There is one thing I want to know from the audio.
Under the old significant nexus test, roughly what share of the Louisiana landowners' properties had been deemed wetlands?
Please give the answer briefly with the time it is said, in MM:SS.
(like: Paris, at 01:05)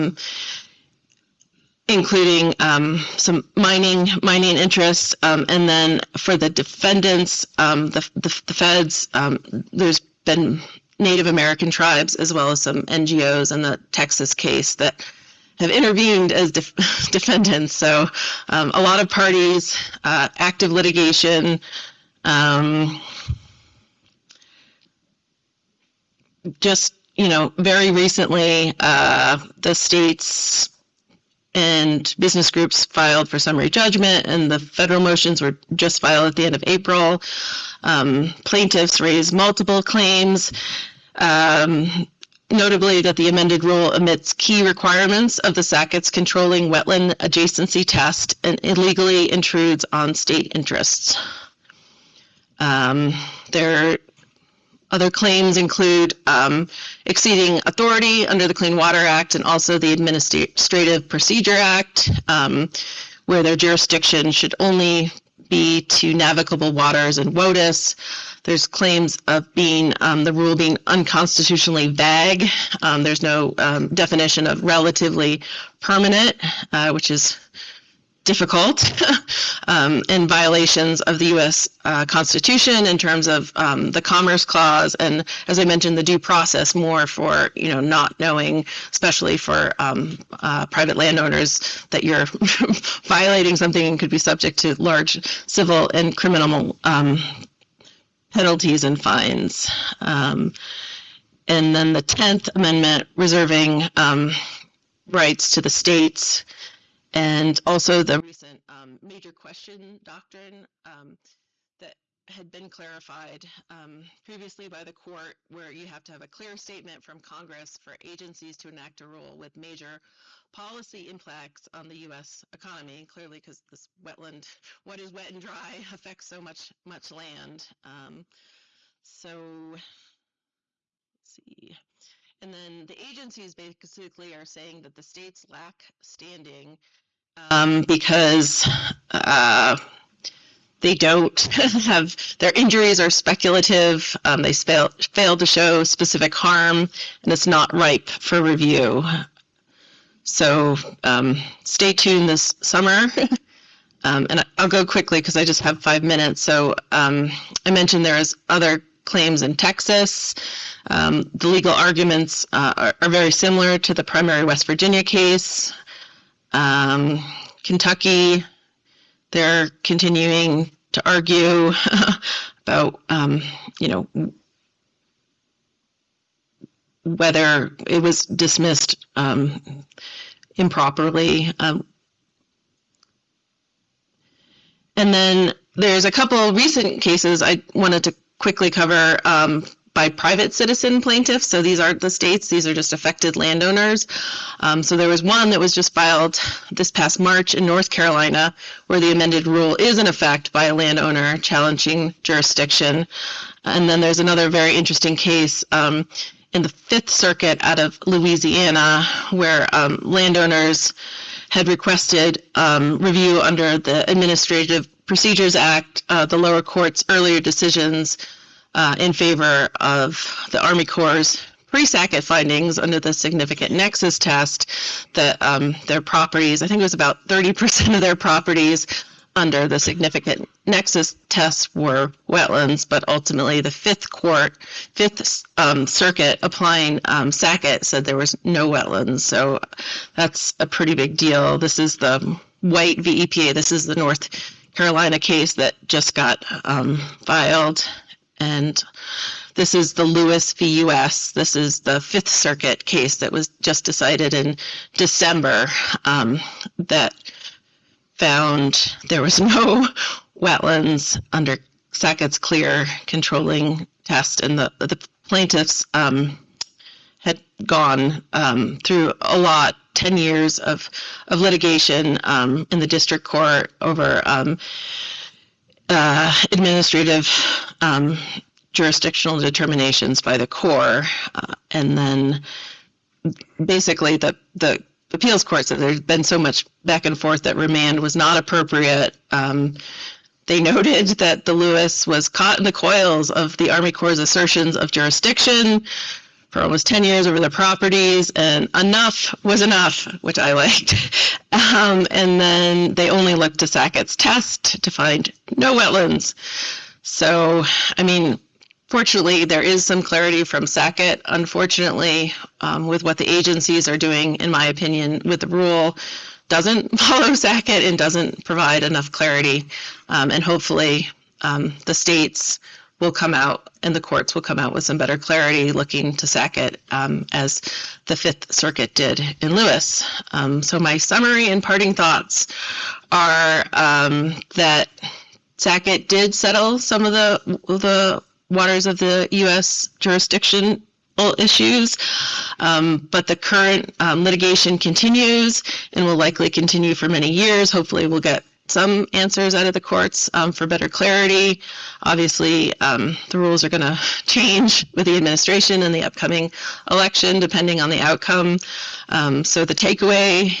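30%, at 03:47.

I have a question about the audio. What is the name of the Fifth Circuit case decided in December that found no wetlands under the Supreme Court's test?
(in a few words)
Lewis v. U.S.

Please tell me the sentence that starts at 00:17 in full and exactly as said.
So um, a lot of parties, uh, active litigation.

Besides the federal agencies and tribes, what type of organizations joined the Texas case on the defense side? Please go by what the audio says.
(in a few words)
NGOs.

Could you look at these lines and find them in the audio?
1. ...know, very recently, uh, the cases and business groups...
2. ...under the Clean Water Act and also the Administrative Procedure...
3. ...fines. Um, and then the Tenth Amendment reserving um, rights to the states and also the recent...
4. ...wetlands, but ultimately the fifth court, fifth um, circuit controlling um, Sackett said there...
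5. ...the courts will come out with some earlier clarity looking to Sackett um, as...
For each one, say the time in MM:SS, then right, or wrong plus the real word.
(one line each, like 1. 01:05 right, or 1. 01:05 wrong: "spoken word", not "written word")
1. 00:27 wrong: "states", not "cases"
2. 00:58 right
3. 01:39 right
4. 03:52 wrong: "applying", not "controlling"
5. 05:23 wrong: "better", not "earlier".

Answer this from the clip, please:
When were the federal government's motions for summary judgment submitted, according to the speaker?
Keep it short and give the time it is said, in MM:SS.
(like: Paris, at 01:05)
end of April, at 00:36.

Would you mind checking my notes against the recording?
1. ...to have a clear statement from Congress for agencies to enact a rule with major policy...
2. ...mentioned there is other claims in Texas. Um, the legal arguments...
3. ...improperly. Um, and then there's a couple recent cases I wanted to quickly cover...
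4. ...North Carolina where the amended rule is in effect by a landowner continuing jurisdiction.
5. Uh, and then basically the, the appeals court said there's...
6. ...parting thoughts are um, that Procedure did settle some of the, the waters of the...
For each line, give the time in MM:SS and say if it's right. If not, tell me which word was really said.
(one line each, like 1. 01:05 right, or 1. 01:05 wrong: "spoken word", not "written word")
1. 01:56 right
2. 02:37 right
3. 03:00 right
4. 03:17 wrong: "challenging", not "continuing"
5. 04:41 right
6. 05:31 wrong: "Sackett", not "Procedure".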